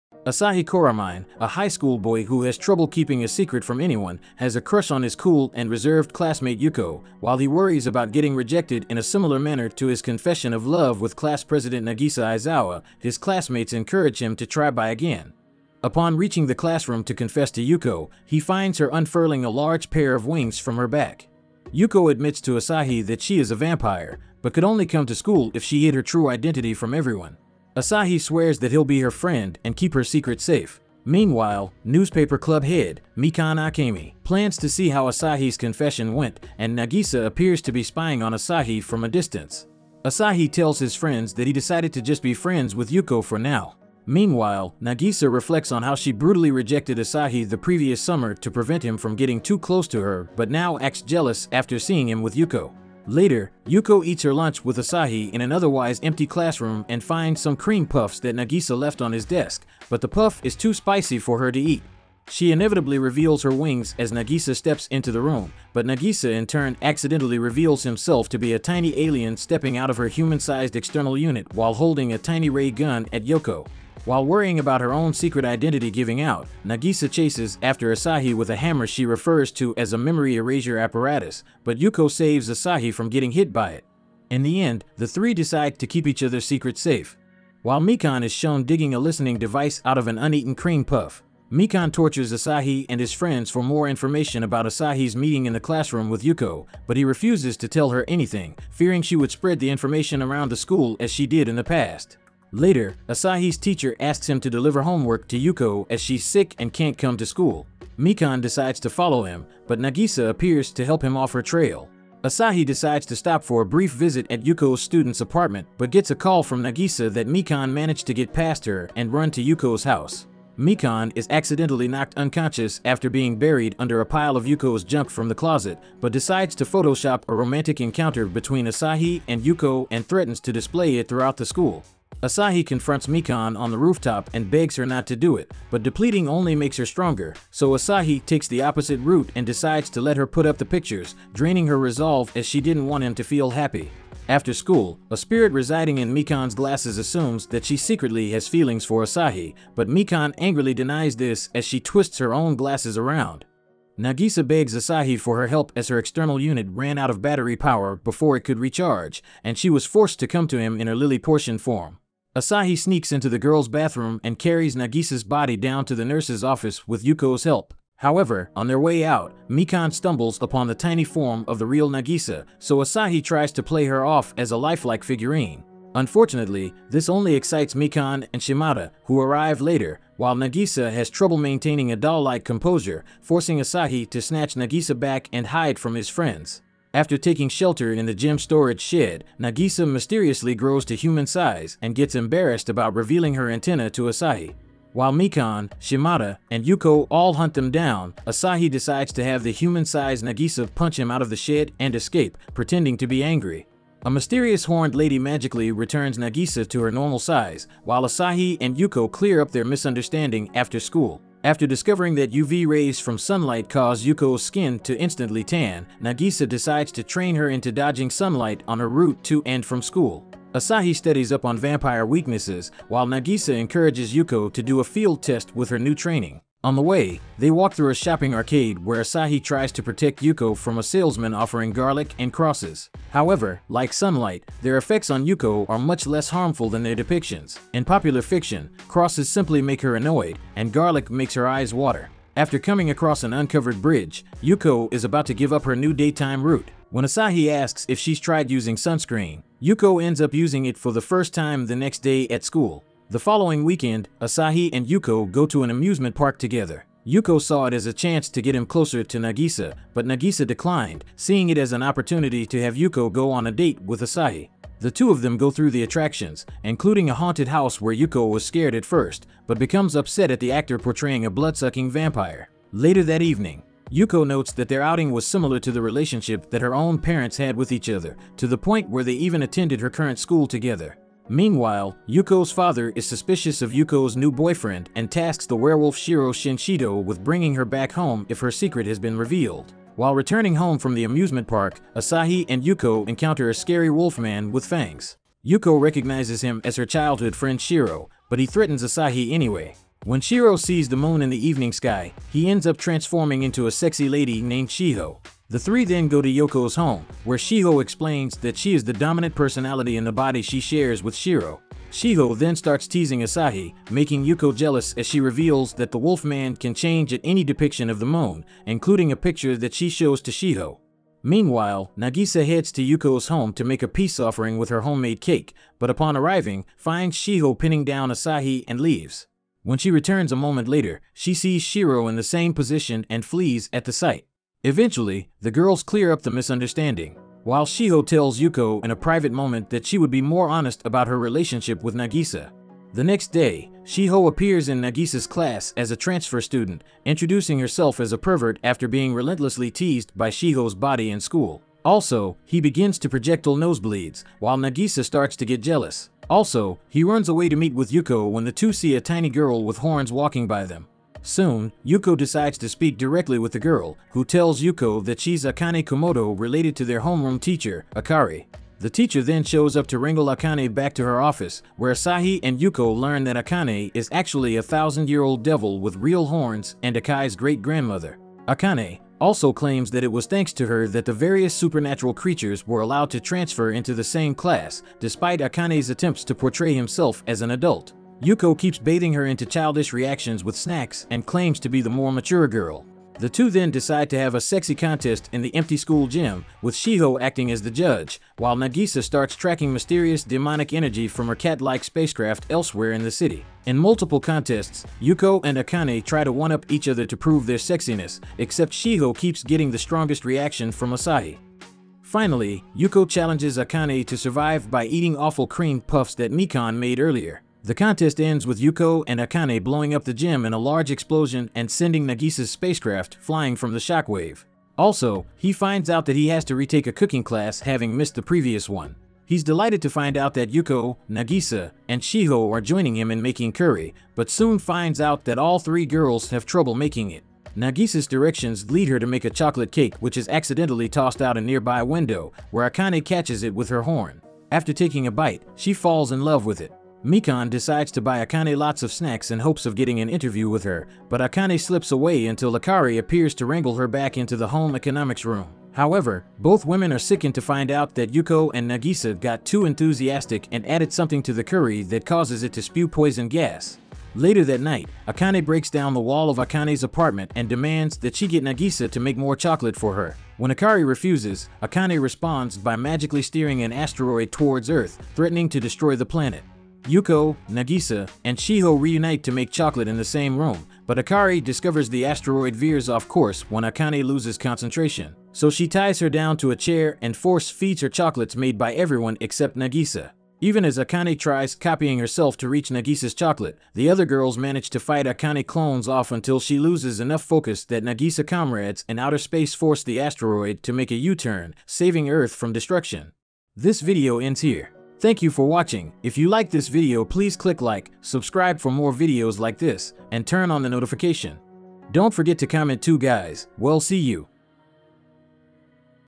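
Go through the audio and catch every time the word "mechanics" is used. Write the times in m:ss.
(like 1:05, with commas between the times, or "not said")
not said.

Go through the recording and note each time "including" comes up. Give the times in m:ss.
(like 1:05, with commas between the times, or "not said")
4:26, 5:18.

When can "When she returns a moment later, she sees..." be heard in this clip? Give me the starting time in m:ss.
5:29.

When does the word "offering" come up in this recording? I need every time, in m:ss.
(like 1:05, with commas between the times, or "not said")
3:51, 5:24.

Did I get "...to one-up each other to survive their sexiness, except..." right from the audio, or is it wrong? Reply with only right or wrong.
wrong.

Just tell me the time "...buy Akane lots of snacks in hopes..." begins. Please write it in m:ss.
7:28.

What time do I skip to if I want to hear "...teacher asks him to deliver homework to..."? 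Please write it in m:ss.
1:43.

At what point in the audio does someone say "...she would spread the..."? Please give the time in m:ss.
1:39.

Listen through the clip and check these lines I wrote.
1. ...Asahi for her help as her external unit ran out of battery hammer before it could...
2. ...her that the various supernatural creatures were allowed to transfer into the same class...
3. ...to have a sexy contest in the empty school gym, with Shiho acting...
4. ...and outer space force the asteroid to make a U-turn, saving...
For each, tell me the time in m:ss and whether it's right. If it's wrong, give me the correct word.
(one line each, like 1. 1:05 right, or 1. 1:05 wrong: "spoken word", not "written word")
1. 2:34 wrong: "power", not "hammer"
2. 6:20 right
3. 6:34 right
4. 8:18 right.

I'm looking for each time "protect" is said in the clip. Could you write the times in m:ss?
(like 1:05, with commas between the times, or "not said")
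3:49.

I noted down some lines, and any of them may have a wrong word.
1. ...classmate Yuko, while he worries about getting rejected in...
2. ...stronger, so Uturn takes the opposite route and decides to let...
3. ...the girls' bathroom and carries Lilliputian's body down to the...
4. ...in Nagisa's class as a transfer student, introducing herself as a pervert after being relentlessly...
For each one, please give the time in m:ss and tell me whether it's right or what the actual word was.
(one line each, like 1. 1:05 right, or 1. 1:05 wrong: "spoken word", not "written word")
1. 0:06 right
2. 2:16 wrong: "Asahi", not "Uturn"
3. 2:43 wrong: "Nagisa", not "Lilliputian"
4. 5:44 right.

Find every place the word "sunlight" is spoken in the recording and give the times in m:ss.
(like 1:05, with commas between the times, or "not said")
3:33, 3:38, 3:53.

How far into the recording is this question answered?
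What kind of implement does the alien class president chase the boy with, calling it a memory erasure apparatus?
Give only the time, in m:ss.
1:18.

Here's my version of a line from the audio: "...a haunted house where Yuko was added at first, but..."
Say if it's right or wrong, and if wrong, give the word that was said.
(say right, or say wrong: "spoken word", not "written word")
wrong: "scared", not "added".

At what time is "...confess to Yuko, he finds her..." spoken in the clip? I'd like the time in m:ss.
0:17.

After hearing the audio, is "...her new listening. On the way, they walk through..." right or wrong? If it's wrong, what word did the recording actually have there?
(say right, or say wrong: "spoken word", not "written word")
wrong: "training", not "listening".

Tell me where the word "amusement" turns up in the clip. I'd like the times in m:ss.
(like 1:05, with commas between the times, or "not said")
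4:15, 4:51.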